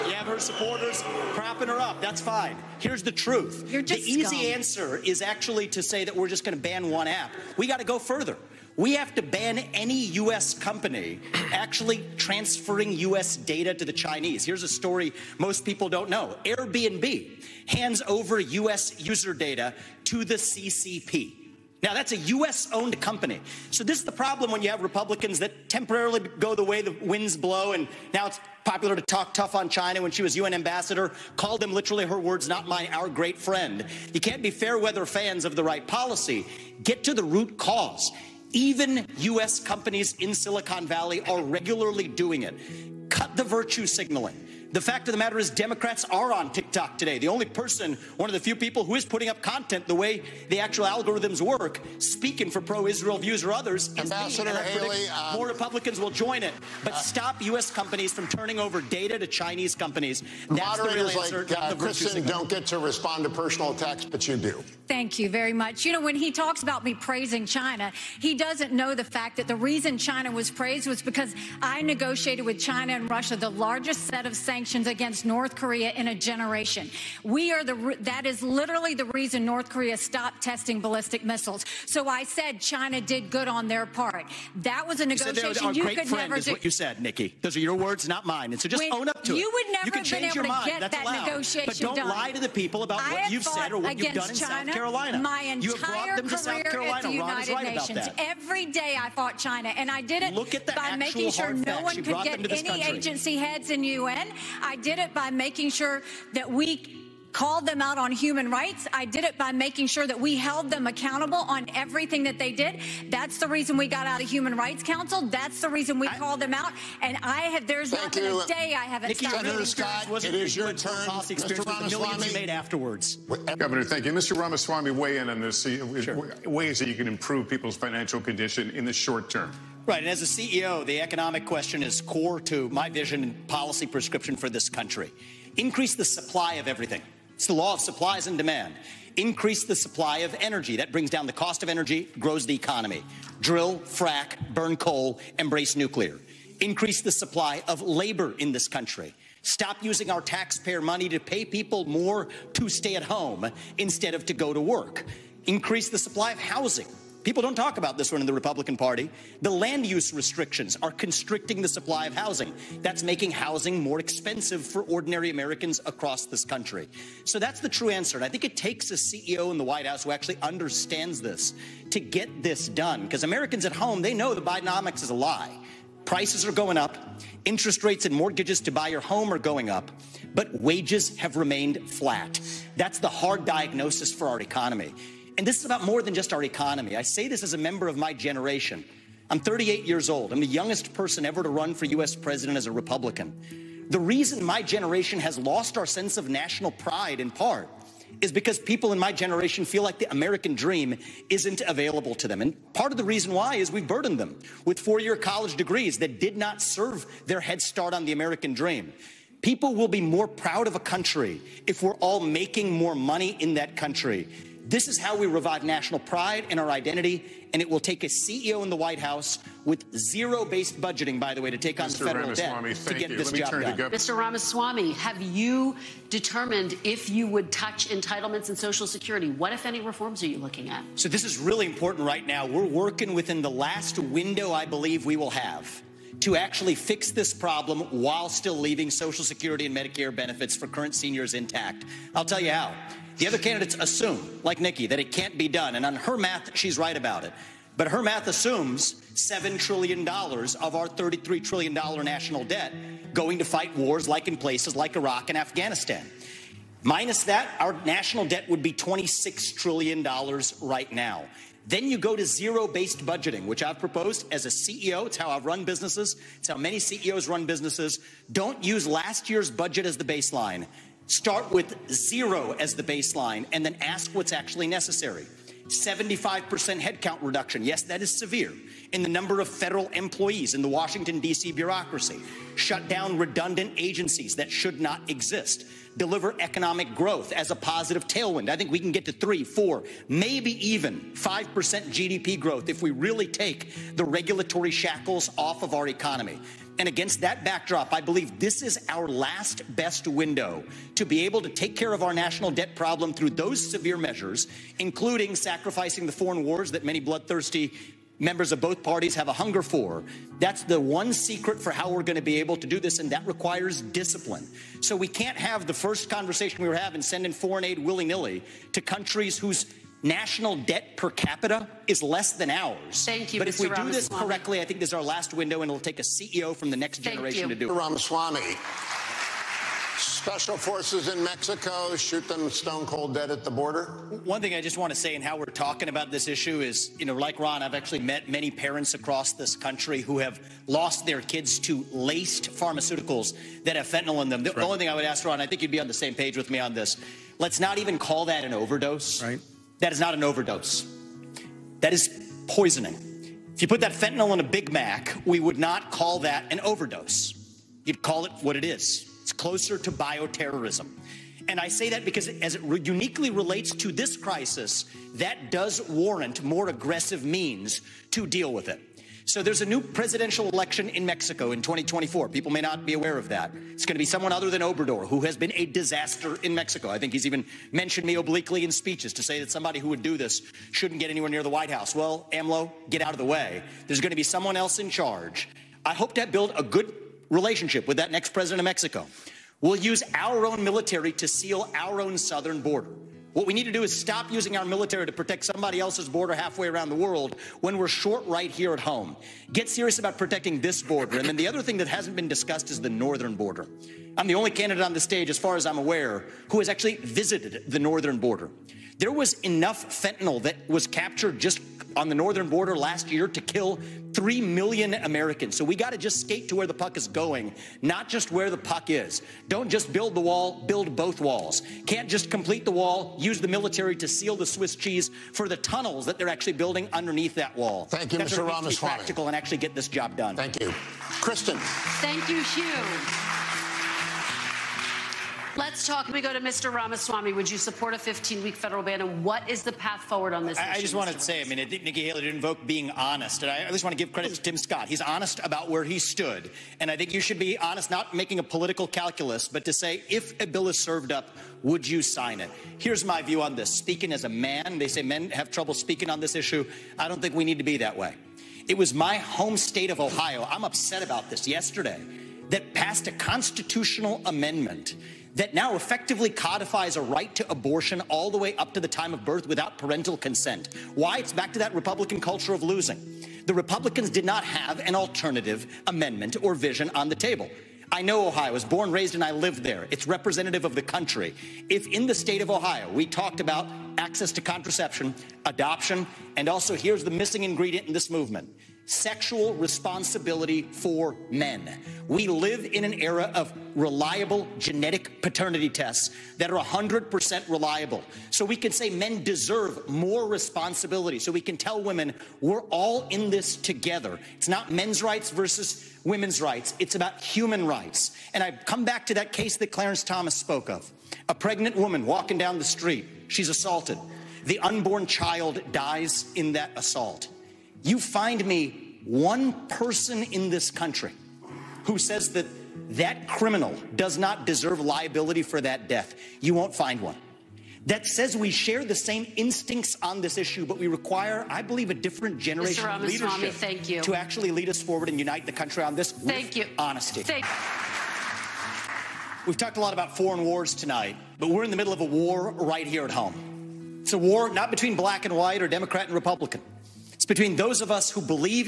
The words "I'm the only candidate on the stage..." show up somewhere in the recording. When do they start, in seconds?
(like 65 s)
404 s.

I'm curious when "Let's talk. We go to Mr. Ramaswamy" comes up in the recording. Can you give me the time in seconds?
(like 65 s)
435 s.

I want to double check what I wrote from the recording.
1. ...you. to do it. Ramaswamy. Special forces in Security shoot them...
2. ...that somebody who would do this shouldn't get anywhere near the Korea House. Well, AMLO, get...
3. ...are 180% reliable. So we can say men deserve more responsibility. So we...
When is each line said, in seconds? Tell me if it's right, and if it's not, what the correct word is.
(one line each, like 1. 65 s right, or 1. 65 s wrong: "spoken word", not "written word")
1. 327 s wrong: "Mexico", not "Security"
2. 379 s wrong: "White", not "Korea"
3. 496 s wrong: "100", not "180".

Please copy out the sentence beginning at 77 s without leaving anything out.
We are the, that is literally the reason North Korea stopped testing ballistic missiles.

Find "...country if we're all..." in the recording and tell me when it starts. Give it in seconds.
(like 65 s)
210 s.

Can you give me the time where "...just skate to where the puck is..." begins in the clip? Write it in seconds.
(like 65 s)
415 s.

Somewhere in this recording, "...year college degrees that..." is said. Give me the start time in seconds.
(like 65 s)
205 s.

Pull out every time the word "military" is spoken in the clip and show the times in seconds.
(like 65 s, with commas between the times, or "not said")
390 s, 394 s, 423 s.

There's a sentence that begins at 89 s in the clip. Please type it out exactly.
You would never you can change your mind.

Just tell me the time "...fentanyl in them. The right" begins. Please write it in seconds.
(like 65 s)
343 s.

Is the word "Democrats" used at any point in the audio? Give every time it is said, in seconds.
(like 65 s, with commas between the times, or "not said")
45 s, 545 s.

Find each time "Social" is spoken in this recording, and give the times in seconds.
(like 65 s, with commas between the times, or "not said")
228 s, 238 s.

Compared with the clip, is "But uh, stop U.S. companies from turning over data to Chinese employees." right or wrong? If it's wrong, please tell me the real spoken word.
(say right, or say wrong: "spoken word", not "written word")
wrong: "companies", not "employees".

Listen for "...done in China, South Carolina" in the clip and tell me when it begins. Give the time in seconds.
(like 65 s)
94 s.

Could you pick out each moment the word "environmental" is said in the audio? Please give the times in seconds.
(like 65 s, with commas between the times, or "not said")
not said.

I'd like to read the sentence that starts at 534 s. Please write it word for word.
to actually lead us forward and unite the country on this thank you.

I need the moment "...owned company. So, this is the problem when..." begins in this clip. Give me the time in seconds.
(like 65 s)
22 s.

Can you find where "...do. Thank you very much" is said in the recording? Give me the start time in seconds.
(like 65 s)
64 s.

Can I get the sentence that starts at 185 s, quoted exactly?
And this is about more than just our economy.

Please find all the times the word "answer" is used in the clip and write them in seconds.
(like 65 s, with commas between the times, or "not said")
4 s, 60 s, 167 s.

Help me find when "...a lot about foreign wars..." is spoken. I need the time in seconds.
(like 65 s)
539 s.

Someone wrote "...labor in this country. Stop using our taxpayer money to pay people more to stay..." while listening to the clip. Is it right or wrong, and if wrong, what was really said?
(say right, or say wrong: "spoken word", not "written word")
right.